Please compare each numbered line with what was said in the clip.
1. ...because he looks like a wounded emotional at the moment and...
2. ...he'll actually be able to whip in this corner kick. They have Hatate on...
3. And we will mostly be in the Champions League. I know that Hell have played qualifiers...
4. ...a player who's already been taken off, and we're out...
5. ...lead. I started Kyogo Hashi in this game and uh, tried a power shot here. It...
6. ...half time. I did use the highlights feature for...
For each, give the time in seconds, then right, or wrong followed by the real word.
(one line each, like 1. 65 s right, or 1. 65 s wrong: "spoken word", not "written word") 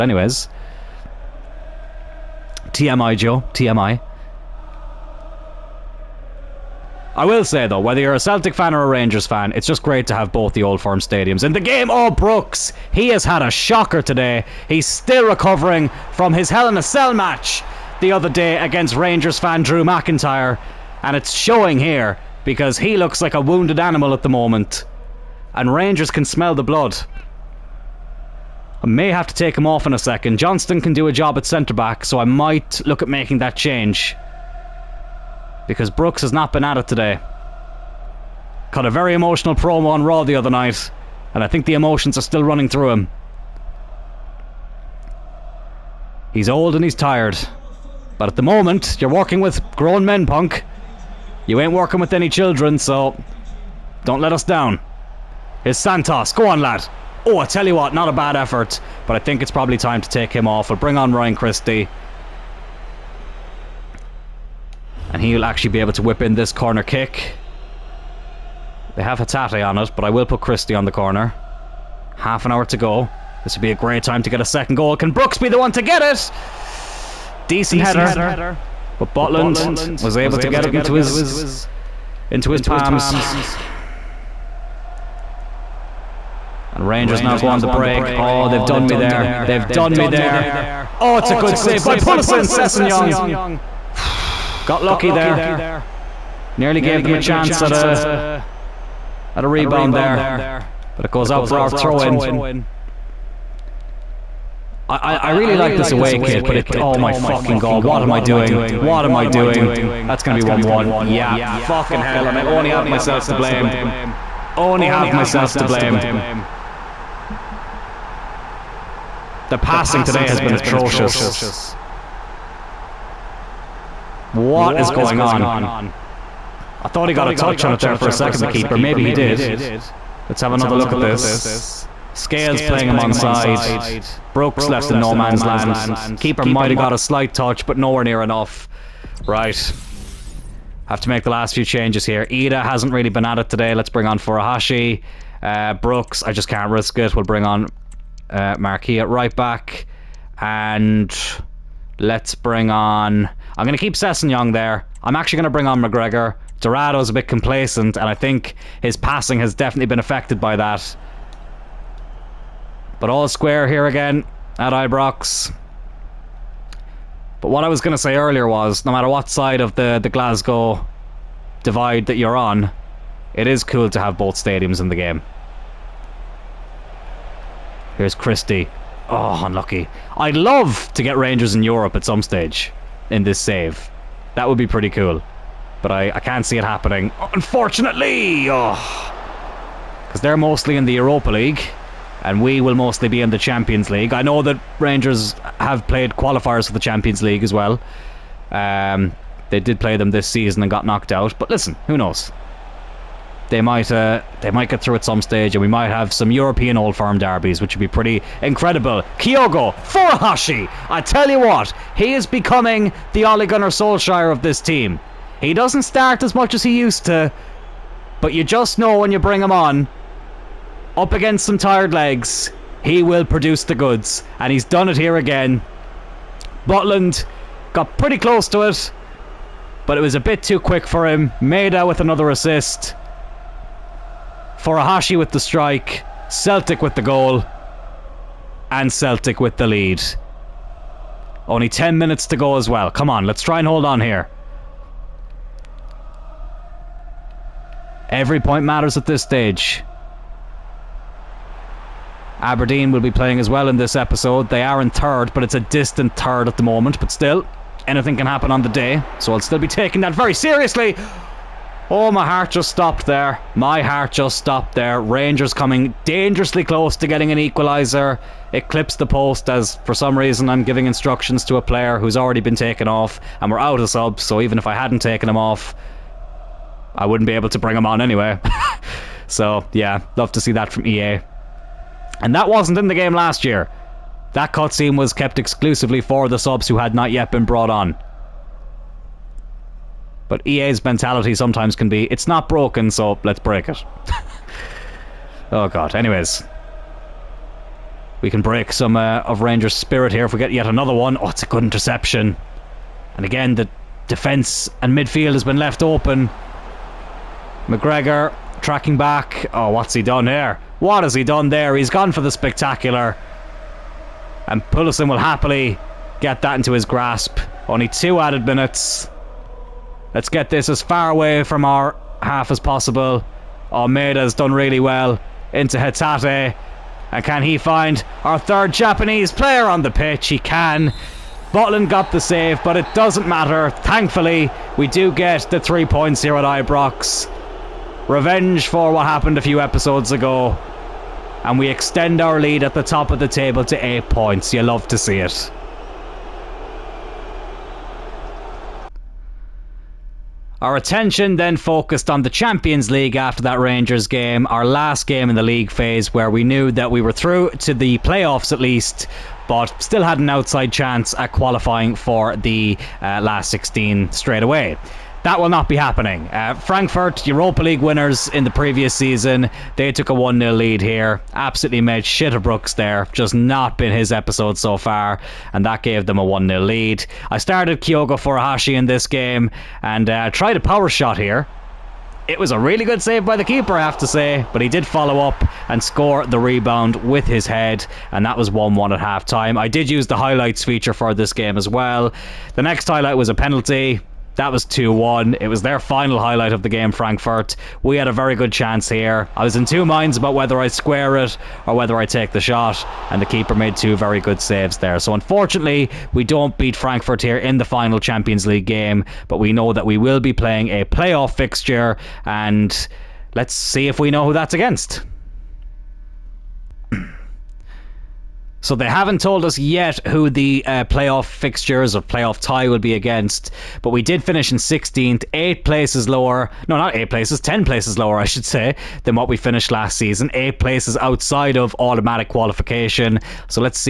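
1. 22 s wrong: "animal", not "emotional"
2. 65 s right
3. 192 s wrong: "Rangers", not "Hell"
4. 271 s right
5. 376 s right
6. 389 s right.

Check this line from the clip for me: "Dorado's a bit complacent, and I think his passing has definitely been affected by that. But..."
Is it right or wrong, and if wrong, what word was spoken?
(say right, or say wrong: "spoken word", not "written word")
right.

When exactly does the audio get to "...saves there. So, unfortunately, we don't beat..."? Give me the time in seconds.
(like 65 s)
404 s.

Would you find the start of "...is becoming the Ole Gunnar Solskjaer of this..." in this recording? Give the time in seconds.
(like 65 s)
212 s.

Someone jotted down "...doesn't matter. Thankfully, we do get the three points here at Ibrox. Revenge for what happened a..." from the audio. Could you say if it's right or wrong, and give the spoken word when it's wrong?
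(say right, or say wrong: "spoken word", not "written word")
right.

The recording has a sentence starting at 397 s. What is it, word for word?
We had a very good chance here.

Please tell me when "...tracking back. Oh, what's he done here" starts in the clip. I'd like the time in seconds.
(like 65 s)
308 s.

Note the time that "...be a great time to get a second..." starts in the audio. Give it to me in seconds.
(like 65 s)
73 s.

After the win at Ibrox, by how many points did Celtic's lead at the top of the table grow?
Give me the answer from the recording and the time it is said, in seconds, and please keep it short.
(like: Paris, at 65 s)
8, at 343 s.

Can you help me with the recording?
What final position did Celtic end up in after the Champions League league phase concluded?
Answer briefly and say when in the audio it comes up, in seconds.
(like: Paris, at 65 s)
16th, at 424 s.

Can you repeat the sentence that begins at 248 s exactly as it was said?
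Every point matters at this stage.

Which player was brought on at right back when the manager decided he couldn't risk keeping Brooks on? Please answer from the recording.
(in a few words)
Marquis.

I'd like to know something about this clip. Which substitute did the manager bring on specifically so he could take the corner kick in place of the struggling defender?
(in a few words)
Ryan Christie.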